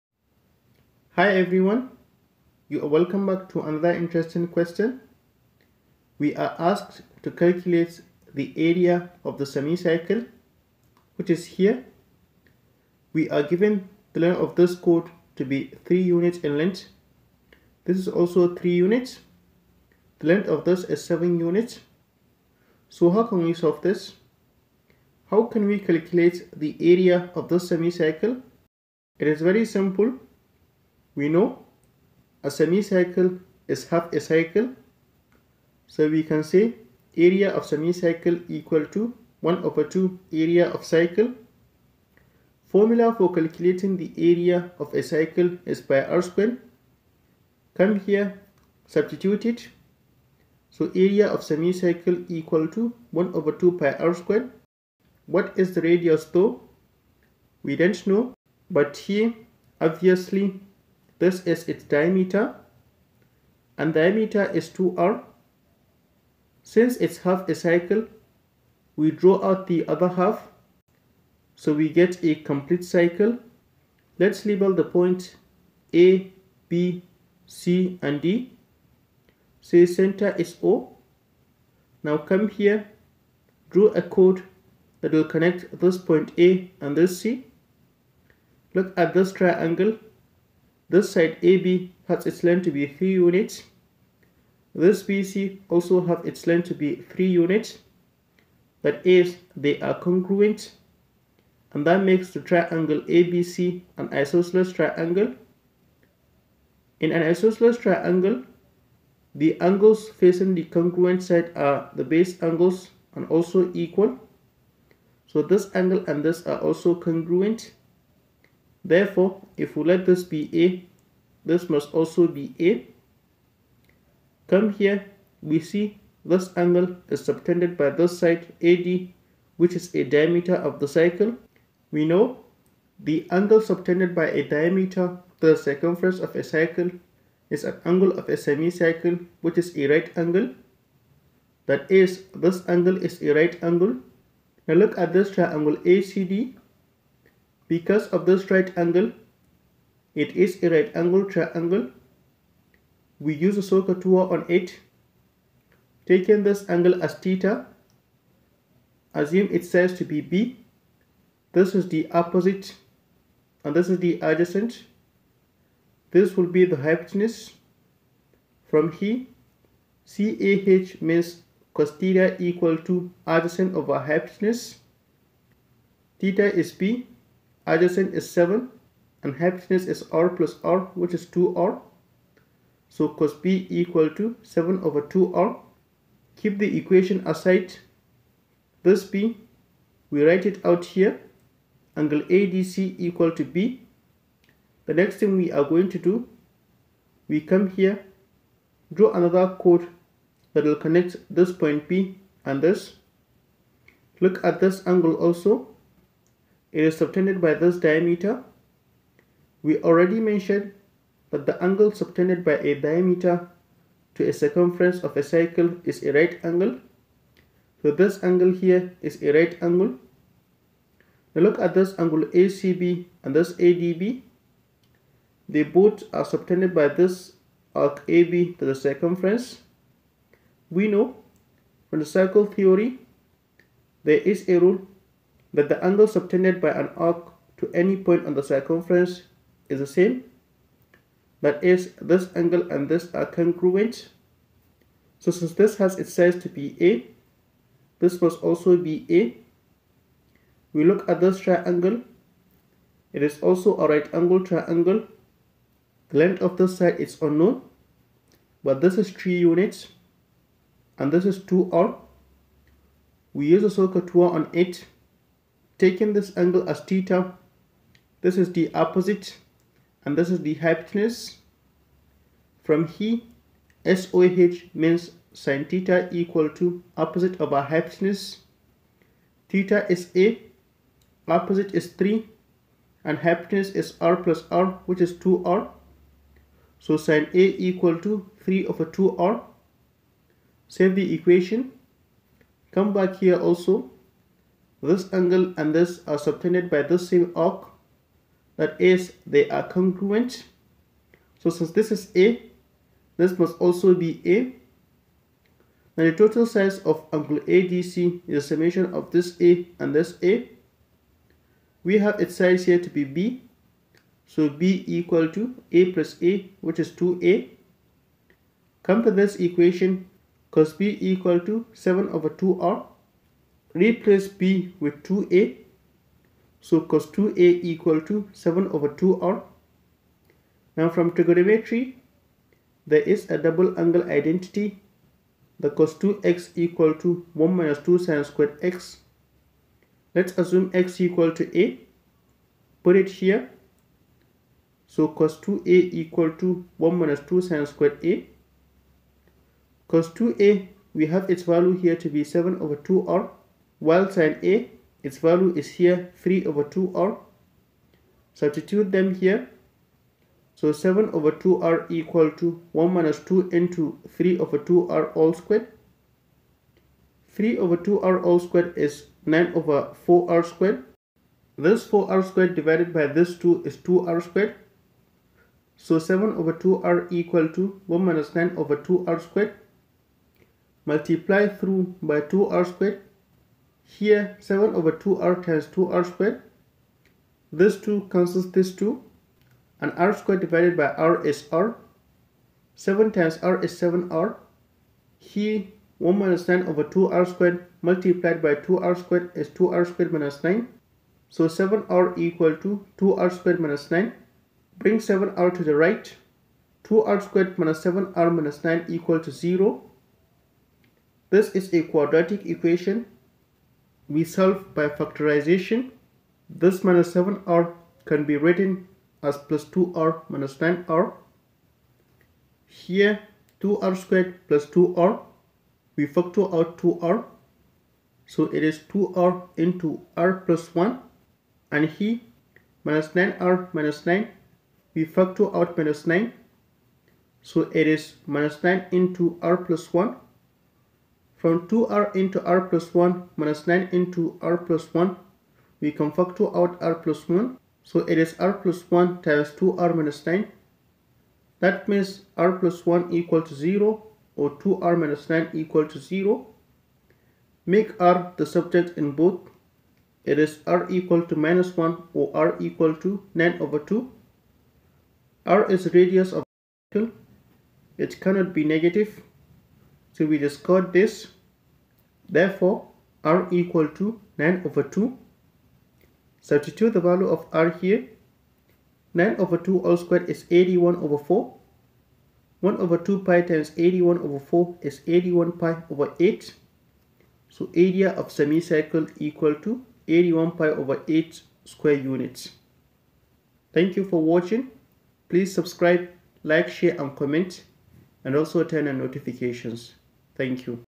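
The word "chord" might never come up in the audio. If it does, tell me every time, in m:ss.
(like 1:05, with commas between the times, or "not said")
0:14, 1:24, 3:19.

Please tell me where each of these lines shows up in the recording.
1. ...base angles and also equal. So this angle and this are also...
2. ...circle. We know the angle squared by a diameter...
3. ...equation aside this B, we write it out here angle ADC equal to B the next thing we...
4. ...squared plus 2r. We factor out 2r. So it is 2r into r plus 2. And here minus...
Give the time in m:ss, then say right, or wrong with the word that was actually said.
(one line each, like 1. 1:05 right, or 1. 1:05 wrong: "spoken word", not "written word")
1. 1:52 right
2. 2:10 wrong: "subtended", not "squared"
3. 3:06 right
4. 7:03 wrong: "1", not "2".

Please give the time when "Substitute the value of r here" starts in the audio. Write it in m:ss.
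7:56.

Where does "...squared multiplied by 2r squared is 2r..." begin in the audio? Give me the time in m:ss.
6:37.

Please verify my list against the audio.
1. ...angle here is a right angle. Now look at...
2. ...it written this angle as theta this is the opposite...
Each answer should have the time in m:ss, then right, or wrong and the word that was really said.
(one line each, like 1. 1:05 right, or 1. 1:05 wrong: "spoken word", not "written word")
1. 3:38 right
2. 4:24 wrong: "taken", not "written".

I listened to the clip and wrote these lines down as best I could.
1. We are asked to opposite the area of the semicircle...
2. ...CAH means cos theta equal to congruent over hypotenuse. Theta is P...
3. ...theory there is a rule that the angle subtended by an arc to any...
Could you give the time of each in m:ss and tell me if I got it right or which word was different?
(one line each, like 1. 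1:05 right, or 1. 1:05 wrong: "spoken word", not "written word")
1. 0:06 wrong: "calculate", not "opposite"
2. 2:50 wrong: "adjacent", not "congruent"
3. 3:52 right.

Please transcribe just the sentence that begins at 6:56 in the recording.
This minus 7r can be written as plus 2r minus 9r.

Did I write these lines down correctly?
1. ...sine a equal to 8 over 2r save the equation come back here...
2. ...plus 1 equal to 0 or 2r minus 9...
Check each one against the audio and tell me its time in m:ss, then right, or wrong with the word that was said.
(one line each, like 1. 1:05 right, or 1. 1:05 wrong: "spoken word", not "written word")
1. 4:47 wrong: "3", not "8"
2. 7:32 right.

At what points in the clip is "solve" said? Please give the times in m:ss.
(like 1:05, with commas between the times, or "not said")
0:23, 6:54.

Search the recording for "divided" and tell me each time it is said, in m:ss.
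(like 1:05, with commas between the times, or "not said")
6:12, 6:30.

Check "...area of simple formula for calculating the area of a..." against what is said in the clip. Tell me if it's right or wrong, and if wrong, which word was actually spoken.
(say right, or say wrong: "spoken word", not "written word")
wrong: "cycle", not "simple".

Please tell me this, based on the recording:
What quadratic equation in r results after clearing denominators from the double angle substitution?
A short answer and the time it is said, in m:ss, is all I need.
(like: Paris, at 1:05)
2r² − 7r − 9 = 0, at 6:46.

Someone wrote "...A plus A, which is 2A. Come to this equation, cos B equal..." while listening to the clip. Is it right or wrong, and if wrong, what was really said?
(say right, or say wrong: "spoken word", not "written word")
right.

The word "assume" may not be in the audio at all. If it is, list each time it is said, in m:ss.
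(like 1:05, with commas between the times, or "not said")
2:39, 5:40.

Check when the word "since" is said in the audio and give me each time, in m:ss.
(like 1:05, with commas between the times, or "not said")
1:06, 4:05, 5:01.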